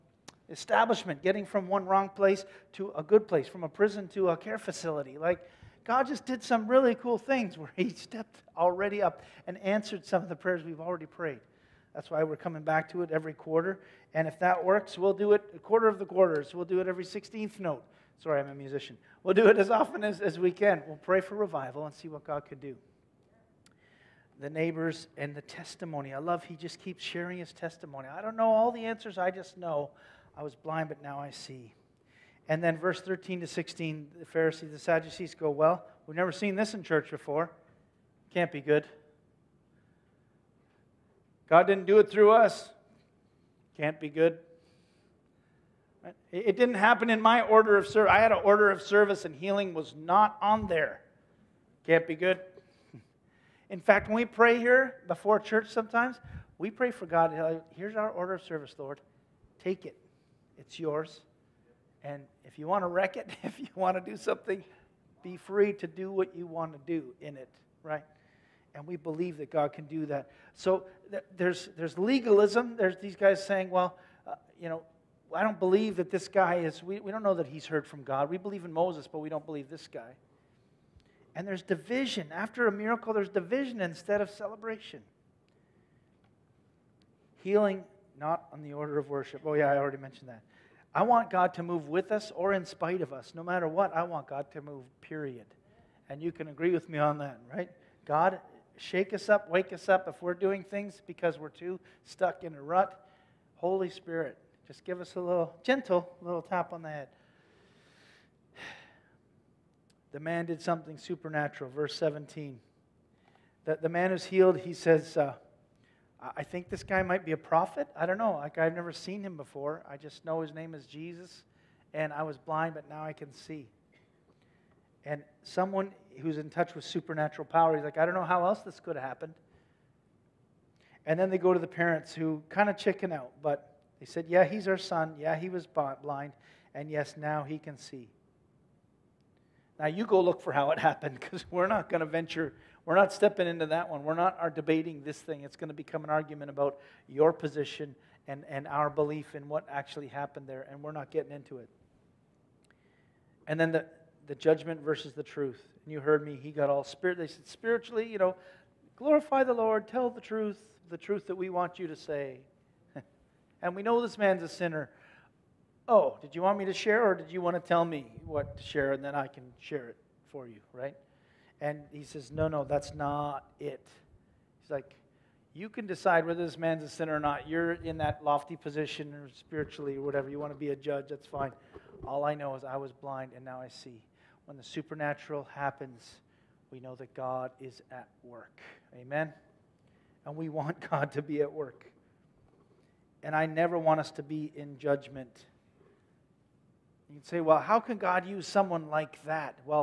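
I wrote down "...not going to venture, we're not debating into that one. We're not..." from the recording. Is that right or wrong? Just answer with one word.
wrong.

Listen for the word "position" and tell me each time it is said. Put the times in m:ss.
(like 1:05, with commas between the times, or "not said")
2:27, 2:58.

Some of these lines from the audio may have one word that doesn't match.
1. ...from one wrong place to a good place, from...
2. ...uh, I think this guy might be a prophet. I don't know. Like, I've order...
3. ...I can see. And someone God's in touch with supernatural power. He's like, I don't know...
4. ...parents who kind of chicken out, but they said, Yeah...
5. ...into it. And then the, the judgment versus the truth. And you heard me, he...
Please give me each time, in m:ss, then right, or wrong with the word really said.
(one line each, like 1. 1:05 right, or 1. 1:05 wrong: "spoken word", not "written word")
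1. 0:01 right
2. 1:55 wrong: "never", not "order"
3. 2:03 wrong: "Who", not "God"
4. 2:11 right
5. 2:31 right.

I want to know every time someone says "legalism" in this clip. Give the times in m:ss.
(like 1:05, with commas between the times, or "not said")
1:11.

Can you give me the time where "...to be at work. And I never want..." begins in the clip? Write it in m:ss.
3:11.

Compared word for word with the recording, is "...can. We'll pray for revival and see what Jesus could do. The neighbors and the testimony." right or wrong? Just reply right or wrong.
wrong.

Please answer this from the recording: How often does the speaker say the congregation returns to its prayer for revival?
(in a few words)
every quarter.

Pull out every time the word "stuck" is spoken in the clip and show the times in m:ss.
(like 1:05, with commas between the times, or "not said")
1:42.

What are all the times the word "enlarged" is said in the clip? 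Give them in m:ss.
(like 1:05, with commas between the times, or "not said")
not said.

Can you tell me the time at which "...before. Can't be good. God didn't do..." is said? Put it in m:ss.
0:37.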